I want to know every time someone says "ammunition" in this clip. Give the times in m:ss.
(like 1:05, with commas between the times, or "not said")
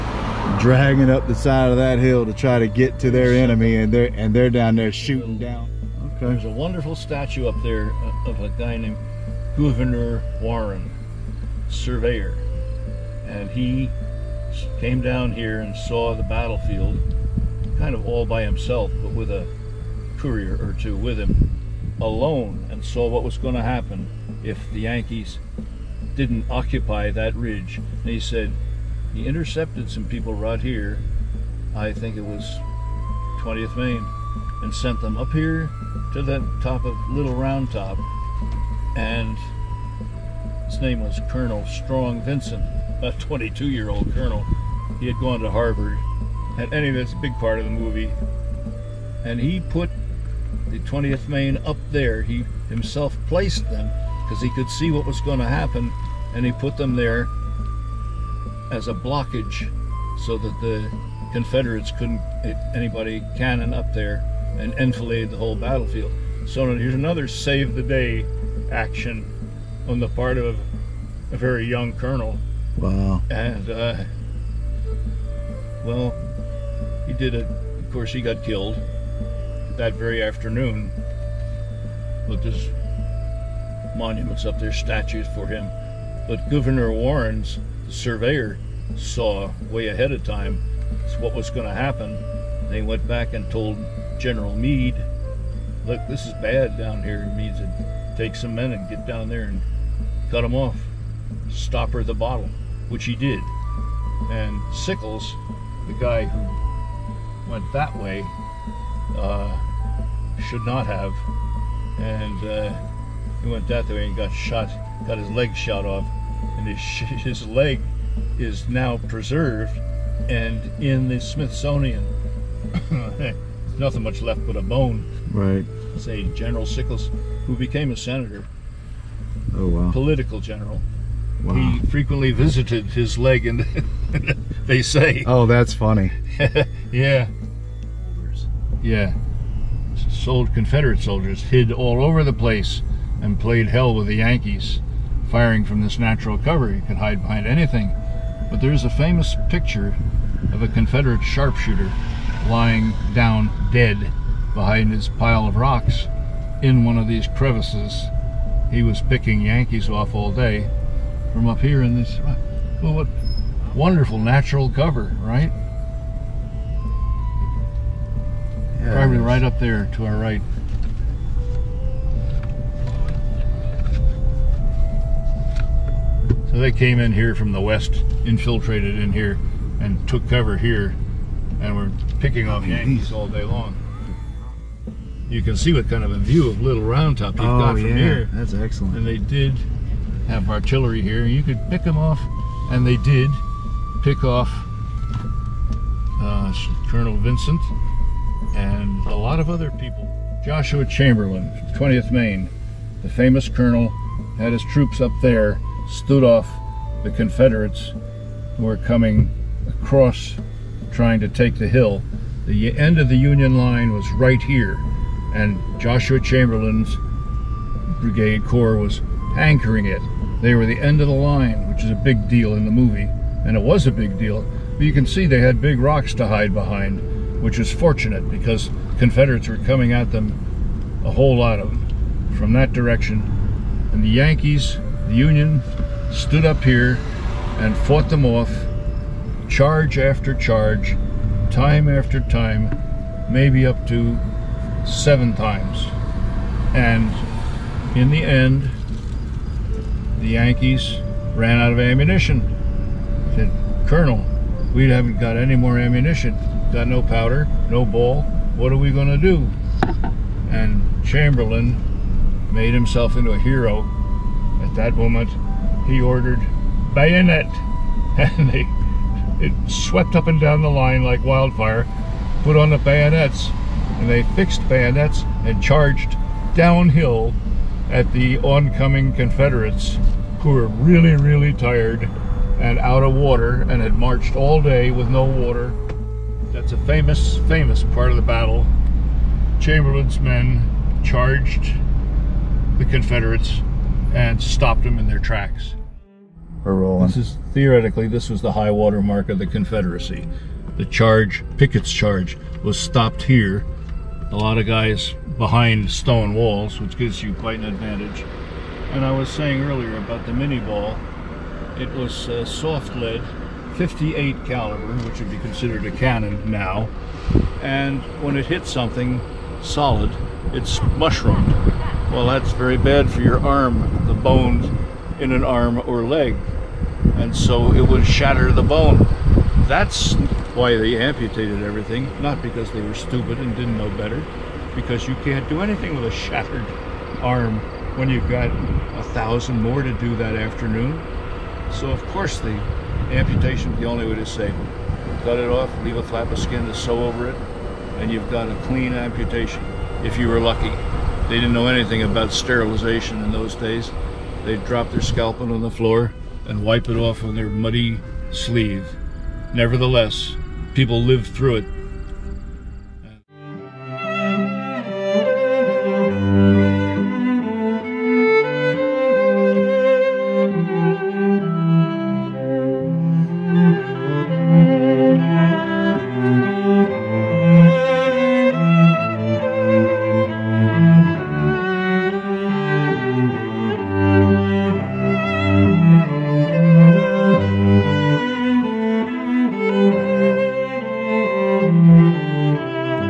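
4:11, 4:15.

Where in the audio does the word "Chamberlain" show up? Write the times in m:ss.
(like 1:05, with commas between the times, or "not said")
3:20, 3:36, 4:21, 4:49.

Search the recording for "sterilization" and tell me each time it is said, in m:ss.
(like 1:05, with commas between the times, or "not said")
5:52.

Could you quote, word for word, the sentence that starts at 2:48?
Yeah, Probably right up there to our right.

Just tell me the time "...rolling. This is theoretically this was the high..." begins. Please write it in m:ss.
4:56.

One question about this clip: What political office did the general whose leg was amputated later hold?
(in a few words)
senator.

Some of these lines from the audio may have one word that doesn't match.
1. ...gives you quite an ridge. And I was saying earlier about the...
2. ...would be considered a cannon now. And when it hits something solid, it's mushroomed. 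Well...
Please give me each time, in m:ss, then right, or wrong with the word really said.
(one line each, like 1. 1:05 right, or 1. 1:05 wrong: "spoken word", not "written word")
1. 5:06 wrong: "advantage", not "ridge"
2. 5:15 right.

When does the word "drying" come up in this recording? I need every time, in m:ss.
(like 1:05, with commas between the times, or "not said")
not said.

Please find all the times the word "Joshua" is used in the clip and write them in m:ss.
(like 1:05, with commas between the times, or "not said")
3:20, 3:35.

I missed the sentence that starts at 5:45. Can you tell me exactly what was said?
Cut it off, leave a flap of skin to sew over it, and you've got a clean amputation, if you were lucky.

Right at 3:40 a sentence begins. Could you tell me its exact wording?
They were the end of the line, which is a big deal in the movie, and it was a big deal.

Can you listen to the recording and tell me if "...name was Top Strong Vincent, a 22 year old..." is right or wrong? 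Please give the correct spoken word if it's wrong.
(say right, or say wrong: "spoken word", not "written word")
wrong: "Colonel", not "Top".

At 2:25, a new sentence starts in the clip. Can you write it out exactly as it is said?
Firing from this natural cover, you could hide behind anything.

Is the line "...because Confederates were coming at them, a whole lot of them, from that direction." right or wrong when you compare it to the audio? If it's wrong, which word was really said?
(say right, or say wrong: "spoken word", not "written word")
right.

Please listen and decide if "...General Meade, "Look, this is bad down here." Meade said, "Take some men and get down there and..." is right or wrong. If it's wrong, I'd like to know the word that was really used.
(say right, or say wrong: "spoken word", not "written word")
right.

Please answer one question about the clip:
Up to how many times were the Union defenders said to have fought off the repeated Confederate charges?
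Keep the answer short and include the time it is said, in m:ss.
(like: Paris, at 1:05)
7, at 4:04.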